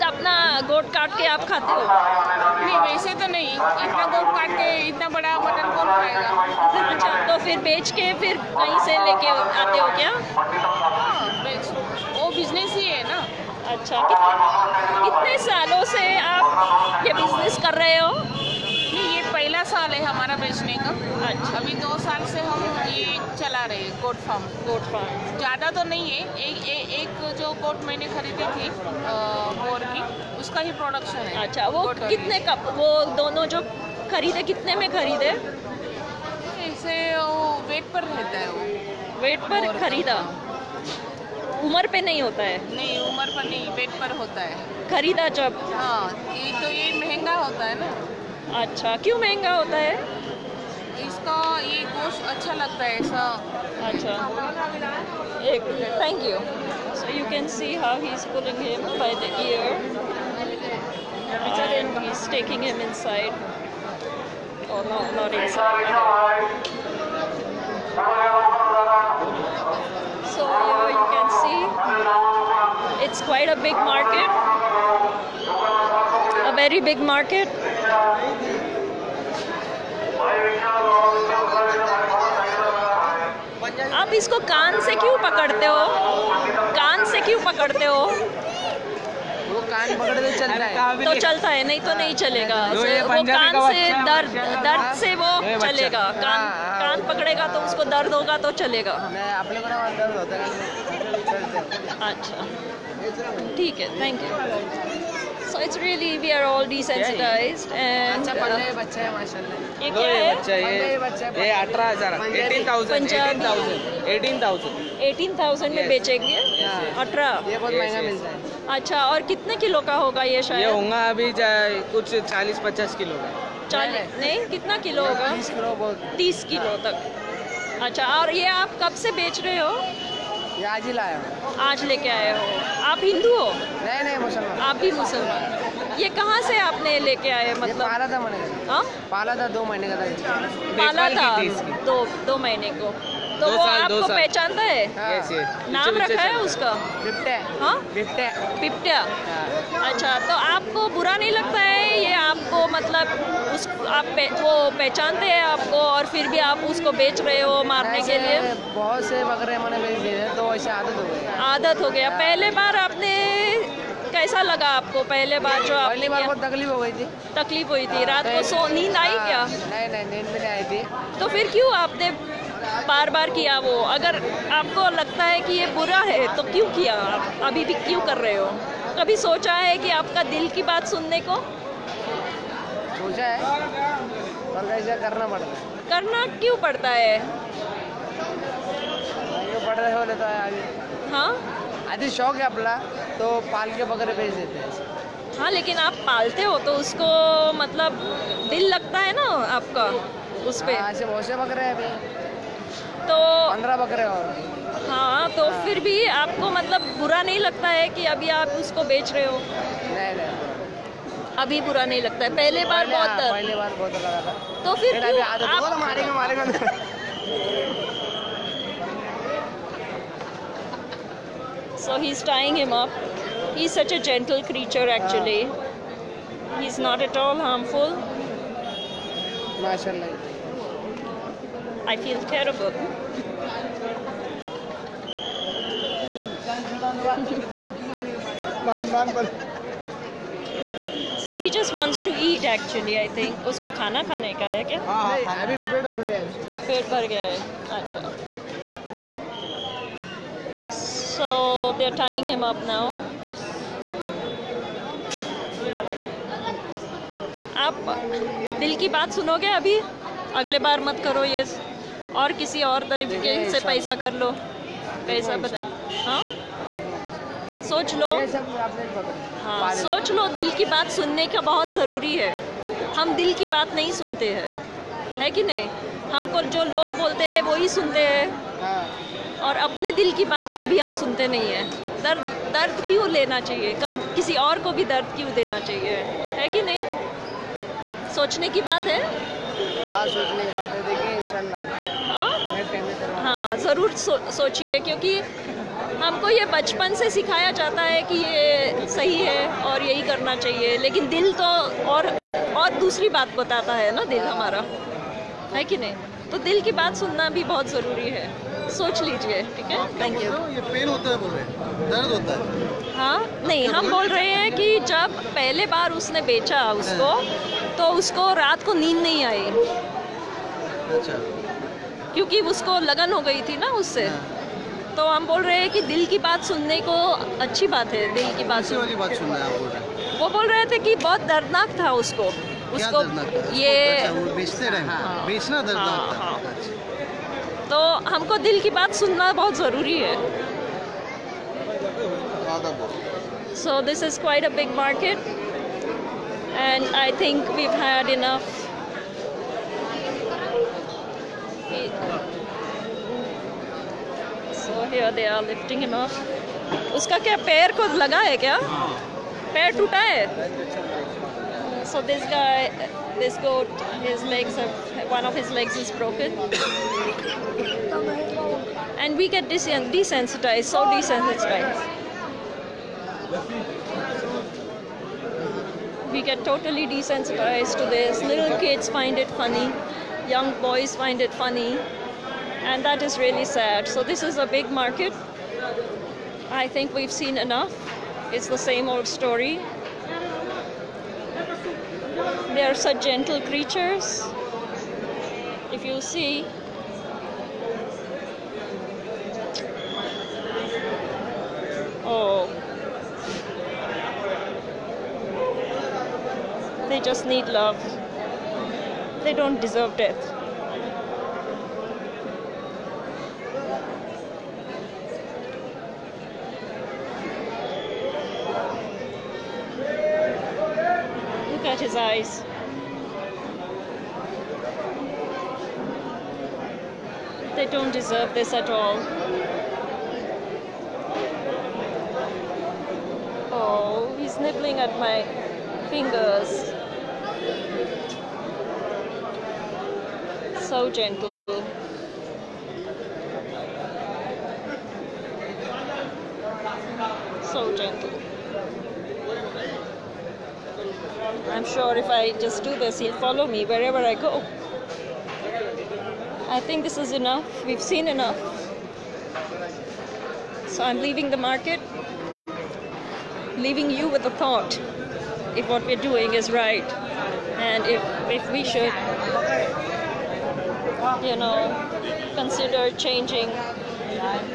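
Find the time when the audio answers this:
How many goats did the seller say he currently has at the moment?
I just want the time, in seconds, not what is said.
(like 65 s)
203 s.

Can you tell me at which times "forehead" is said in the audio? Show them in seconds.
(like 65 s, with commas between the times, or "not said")
not said.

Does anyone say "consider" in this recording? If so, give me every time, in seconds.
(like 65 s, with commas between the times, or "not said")
472 s.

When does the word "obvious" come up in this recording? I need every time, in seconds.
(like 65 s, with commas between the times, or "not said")
not said.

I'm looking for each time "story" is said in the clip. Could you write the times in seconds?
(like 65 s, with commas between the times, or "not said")
389 s.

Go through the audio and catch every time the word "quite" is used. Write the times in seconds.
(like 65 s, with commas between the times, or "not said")
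73 s.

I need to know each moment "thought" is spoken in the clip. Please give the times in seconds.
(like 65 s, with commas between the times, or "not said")
464 s.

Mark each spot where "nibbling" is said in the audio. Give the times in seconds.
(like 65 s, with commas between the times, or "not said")
434 s.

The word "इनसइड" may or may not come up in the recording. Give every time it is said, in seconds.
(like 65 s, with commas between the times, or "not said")
62 s.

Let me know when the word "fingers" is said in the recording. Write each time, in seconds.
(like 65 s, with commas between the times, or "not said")
435 s.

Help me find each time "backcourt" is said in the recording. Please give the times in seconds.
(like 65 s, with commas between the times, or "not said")
not said.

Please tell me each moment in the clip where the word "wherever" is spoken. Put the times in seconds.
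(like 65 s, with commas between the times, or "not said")
453 s.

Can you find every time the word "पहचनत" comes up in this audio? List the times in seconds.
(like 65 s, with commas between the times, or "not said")
144 s, 154 s.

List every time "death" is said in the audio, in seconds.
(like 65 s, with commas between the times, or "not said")
409 s.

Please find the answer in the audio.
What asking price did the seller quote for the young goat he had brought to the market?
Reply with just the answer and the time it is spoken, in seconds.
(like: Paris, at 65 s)
18000, at 111 s.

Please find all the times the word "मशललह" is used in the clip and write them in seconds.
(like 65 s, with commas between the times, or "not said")
109 s, 229 s.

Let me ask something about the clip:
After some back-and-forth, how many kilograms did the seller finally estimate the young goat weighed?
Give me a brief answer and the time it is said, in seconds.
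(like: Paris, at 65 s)
30, at 126 s.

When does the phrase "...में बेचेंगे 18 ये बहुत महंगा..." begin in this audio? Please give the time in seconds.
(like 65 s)
115 s.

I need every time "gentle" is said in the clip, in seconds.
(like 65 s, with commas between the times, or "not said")
393 s, 440 s, 447 s.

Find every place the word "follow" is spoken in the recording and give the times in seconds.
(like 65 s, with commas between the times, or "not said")
453 s.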